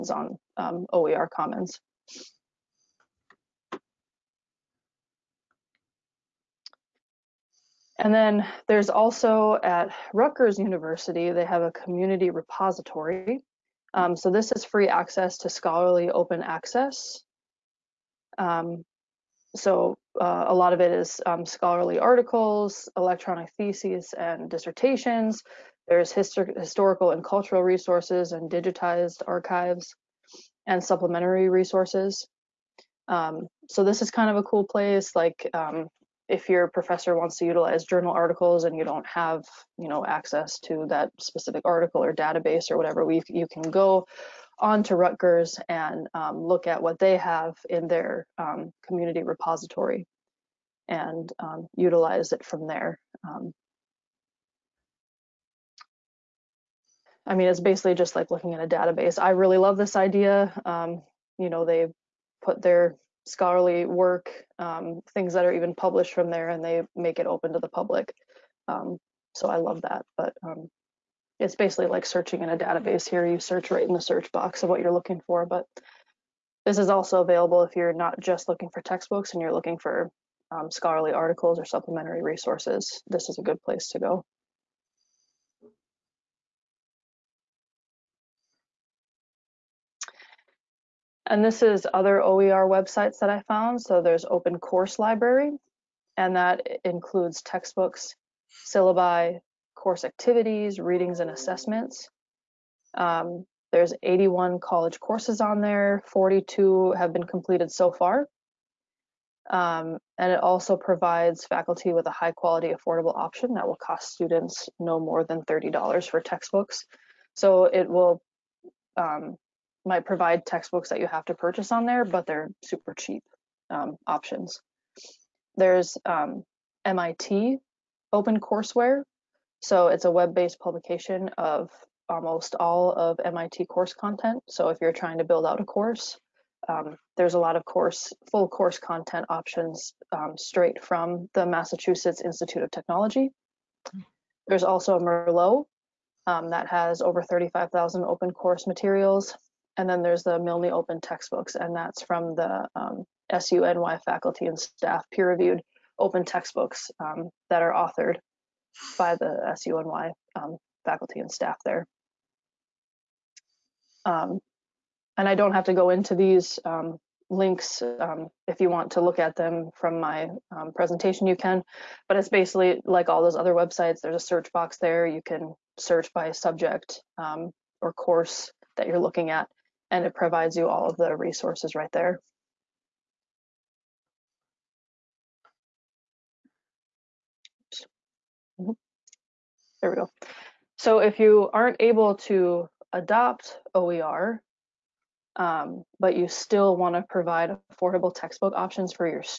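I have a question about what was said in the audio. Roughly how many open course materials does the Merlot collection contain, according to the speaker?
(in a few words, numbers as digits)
over 35,000.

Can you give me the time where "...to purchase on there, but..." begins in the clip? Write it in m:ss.
2:01.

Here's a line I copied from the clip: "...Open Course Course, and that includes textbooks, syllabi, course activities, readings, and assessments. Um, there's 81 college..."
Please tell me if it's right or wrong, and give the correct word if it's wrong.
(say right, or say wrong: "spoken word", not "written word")
wrong: "Library", not "Course".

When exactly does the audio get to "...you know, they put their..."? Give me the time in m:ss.
1:01.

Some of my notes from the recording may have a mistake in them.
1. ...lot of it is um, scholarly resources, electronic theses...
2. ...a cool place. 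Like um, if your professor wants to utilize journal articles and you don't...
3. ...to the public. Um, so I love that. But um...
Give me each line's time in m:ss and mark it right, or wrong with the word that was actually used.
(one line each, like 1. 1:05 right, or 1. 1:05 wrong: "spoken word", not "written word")
1. 0:20 wrong: "articles", not "resources"
2. 0:34 right
3. 1:07 right.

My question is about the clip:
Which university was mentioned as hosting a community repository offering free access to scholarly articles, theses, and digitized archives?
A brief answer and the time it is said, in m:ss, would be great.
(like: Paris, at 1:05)
Rutgers University, at 0:10.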